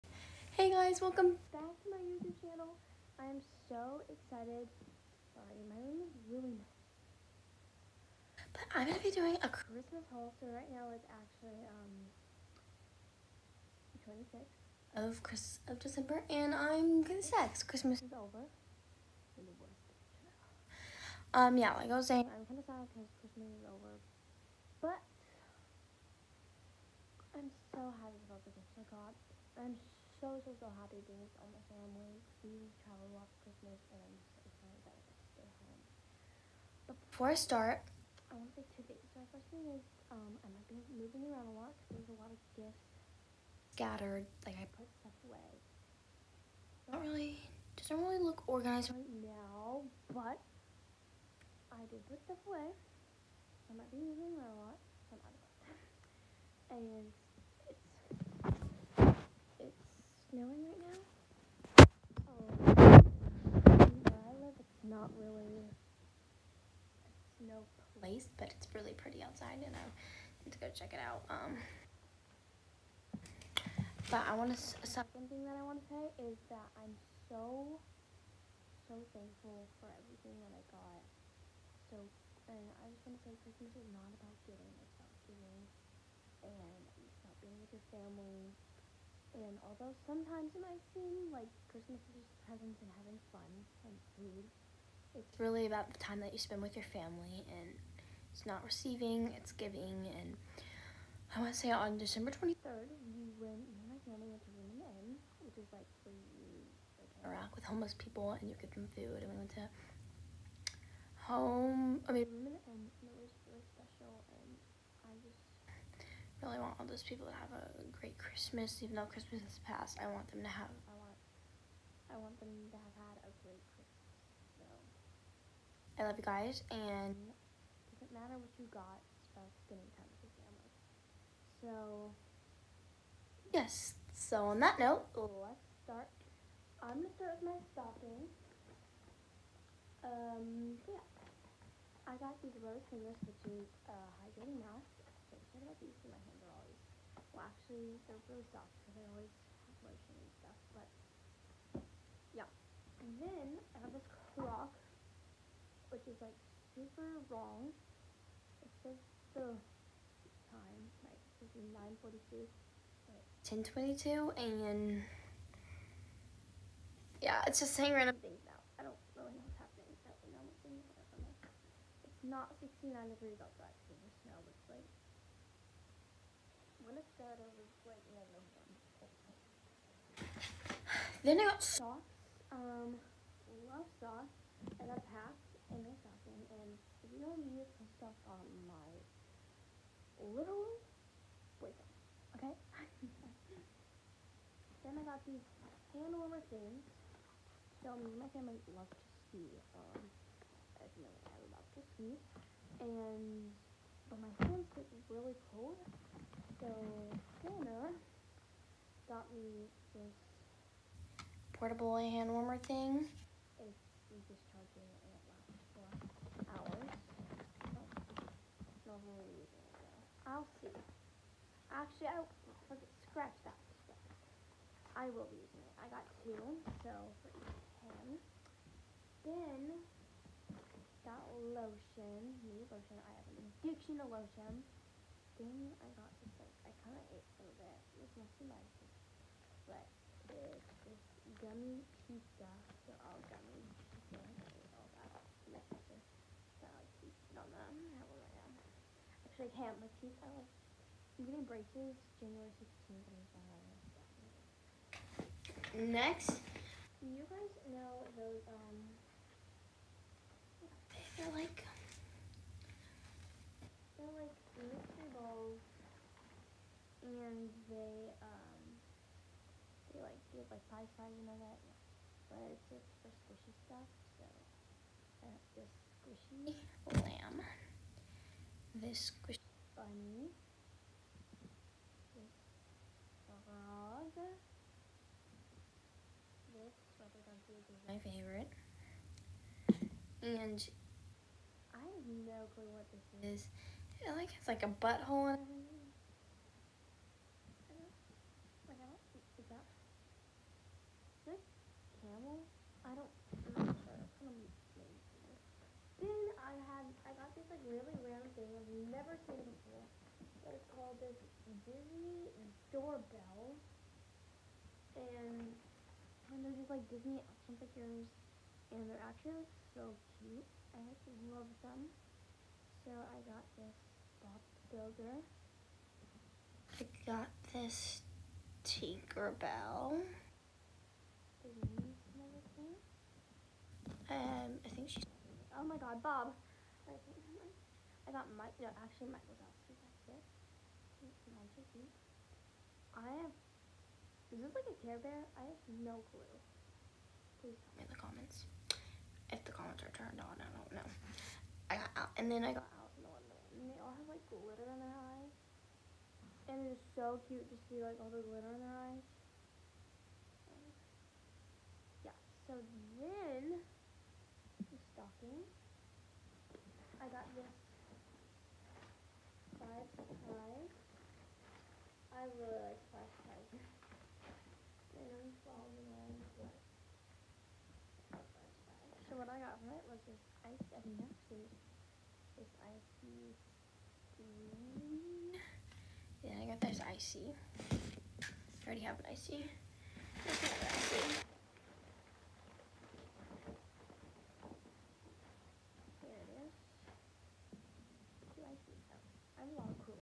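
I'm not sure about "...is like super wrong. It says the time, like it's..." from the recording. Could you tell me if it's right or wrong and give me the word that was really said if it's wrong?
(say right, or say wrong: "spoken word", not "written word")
right.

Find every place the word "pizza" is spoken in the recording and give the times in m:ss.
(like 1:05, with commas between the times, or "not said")
4:02, 4:07.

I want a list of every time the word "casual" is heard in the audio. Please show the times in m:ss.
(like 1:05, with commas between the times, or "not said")
not said.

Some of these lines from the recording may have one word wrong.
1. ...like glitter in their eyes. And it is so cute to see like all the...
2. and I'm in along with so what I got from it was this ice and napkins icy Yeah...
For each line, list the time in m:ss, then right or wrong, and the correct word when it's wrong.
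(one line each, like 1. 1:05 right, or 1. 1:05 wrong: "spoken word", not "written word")
1. 5:54 right
2. 6:14 right.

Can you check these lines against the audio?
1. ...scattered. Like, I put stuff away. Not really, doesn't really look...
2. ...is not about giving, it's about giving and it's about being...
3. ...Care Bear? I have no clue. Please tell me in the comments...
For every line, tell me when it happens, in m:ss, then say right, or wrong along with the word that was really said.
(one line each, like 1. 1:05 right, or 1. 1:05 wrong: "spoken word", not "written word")
1. 0:43 right
2. 1:23 right
3. 5:44 right.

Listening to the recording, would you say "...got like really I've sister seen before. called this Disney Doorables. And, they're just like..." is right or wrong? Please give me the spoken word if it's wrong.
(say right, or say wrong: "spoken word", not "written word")
wrong: "never", not "sister".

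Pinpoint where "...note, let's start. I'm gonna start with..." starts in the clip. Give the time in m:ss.
2:14.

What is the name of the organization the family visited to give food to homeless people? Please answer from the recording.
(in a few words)
Room in the Inn.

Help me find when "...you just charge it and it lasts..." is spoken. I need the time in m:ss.
3:34.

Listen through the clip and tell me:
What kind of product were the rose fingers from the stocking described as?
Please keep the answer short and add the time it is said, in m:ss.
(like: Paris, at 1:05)
hydrating mask, at 2:24.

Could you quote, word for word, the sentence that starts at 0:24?
But I'm so happy about the gifts I got.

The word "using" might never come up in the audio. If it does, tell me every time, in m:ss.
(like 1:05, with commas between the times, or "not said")
3:39, 3:45.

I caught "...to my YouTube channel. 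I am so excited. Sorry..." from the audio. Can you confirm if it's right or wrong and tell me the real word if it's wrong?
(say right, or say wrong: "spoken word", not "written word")
right.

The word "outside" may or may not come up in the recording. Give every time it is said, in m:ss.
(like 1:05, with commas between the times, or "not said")
1:09, 2:53.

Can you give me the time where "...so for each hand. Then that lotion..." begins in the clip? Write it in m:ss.
3:46.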